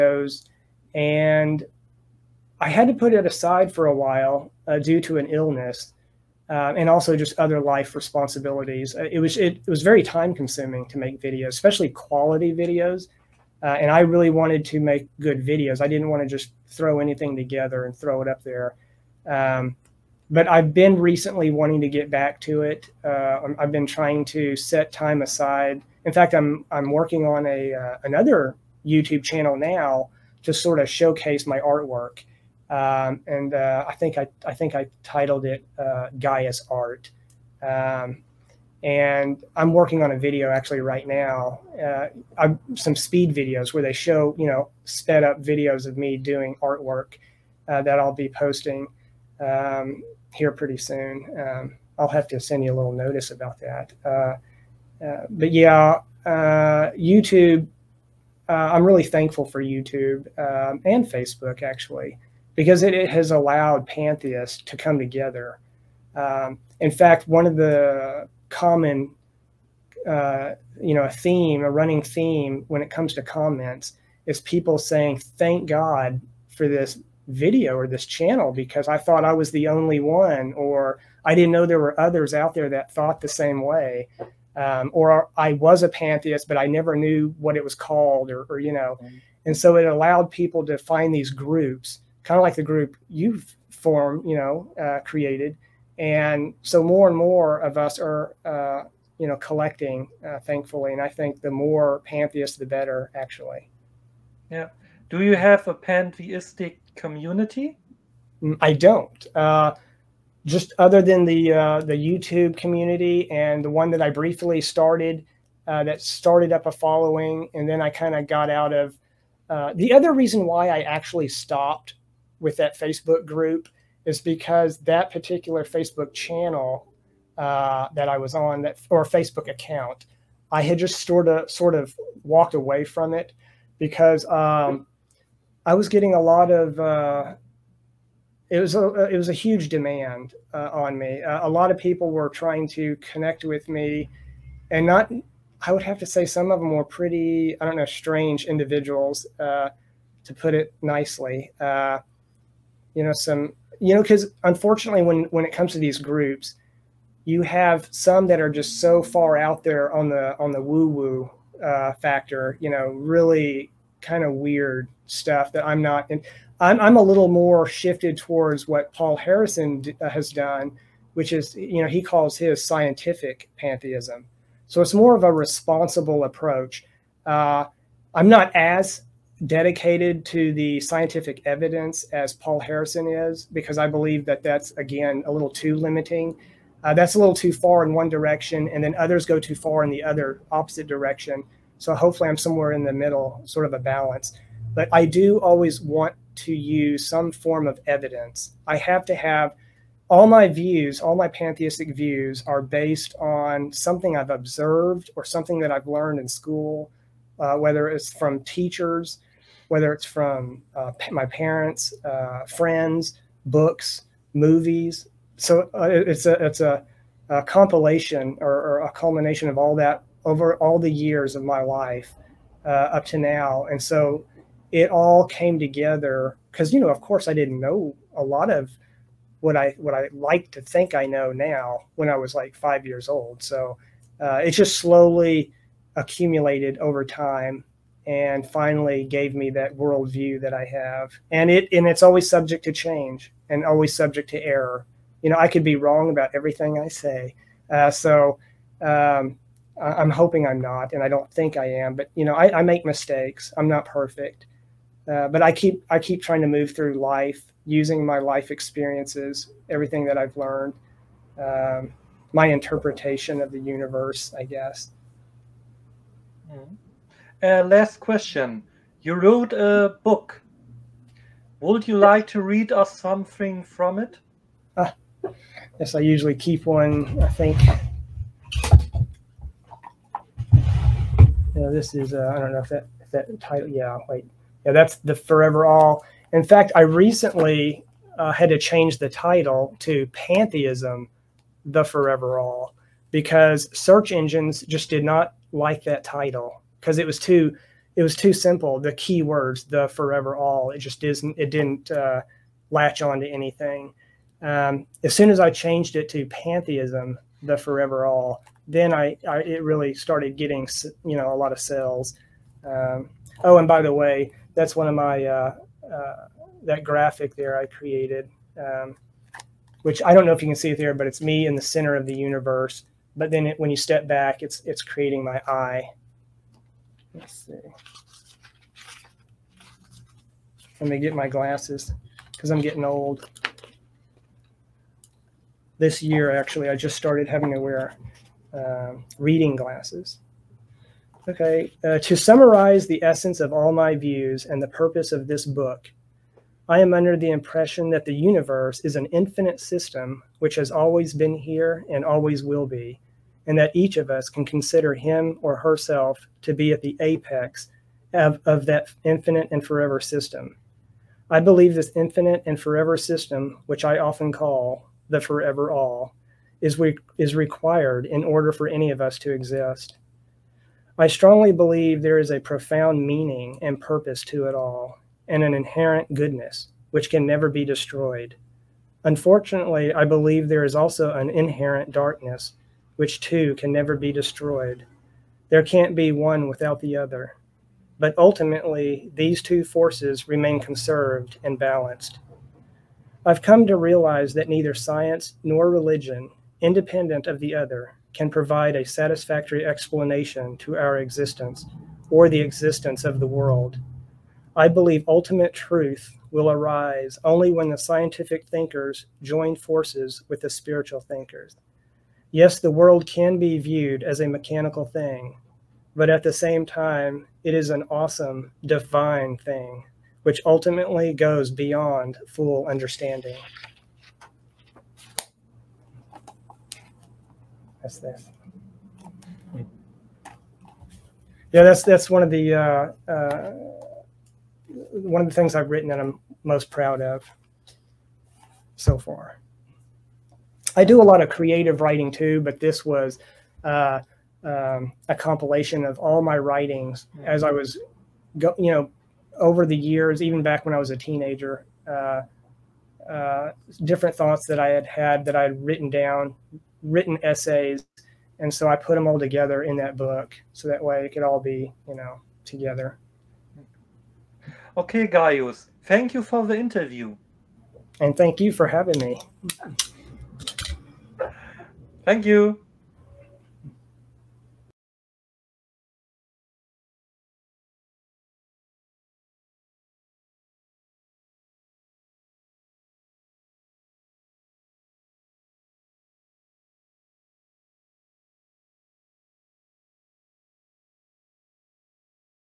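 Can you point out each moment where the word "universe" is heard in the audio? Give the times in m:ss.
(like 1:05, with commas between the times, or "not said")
4:23, 5:22, 5:48.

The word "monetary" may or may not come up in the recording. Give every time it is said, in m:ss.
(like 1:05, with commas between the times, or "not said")
not said.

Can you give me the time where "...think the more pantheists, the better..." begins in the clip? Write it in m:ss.
1:41.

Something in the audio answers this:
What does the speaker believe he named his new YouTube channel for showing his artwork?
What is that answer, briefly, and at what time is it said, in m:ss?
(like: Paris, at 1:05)
Gaia's Art, at 0:36.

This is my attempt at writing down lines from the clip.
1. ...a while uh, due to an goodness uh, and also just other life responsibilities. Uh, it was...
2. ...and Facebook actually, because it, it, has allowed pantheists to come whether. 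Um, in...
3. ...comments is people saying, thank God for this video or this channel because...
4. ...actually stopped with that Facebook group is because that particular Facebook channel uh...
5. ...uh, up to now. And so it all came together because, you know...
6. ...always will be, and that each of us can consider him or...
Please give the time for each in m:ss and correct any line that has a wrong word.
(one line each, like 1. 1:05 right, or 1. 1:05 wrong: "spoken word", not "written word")
1. 0:03 wrong: "illness", not "goodness"
2. 1:00 wrong: "together", not "whether"
3. 1:13 right
4. 2:00 right
5. 3:42 right
6. 5:52 right.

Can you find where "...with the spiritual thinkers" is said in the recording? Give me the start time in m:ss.
6:50.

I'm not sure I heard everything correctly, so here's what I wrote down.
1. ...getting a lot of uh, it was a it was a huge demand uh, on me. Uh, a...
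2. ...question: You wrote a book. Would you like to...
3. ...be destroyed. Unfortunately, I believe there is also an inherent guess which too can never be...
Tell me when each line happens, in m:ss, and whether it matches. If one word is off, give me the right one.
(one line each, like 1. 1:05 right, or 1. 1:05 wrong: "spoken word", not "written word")
1. 2:15 right
2. 4:28 right
3. 6:17 wrong: "darkness", not "guess".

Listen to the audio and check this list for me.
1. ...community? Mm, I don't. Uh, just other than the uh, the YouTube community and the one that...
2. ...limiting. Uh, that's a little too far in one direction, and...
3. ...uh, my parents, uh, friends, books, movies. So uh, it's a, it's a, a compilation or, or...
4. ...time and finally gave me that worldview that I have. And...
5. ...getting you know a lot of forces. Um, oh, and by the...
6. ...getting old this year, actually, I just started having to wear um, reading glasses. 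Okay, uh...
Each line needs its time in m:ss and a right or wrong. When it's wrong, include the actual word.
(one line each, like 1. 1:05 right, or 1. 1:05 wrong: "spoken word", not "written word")
1. 1:46 right
2. 3:05 right
3. 3:30 right
4. 3:57 right
5. 5:10 wrong: "sales", not "forces"
6. 5:32 right.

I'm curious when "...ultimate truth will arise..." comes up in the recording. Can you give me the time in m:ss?
6:45.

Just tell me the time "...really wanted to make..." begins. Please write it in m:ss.
0:13.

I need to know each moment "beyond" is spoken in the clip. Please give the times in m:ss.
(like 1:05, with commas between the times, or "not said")
7:01.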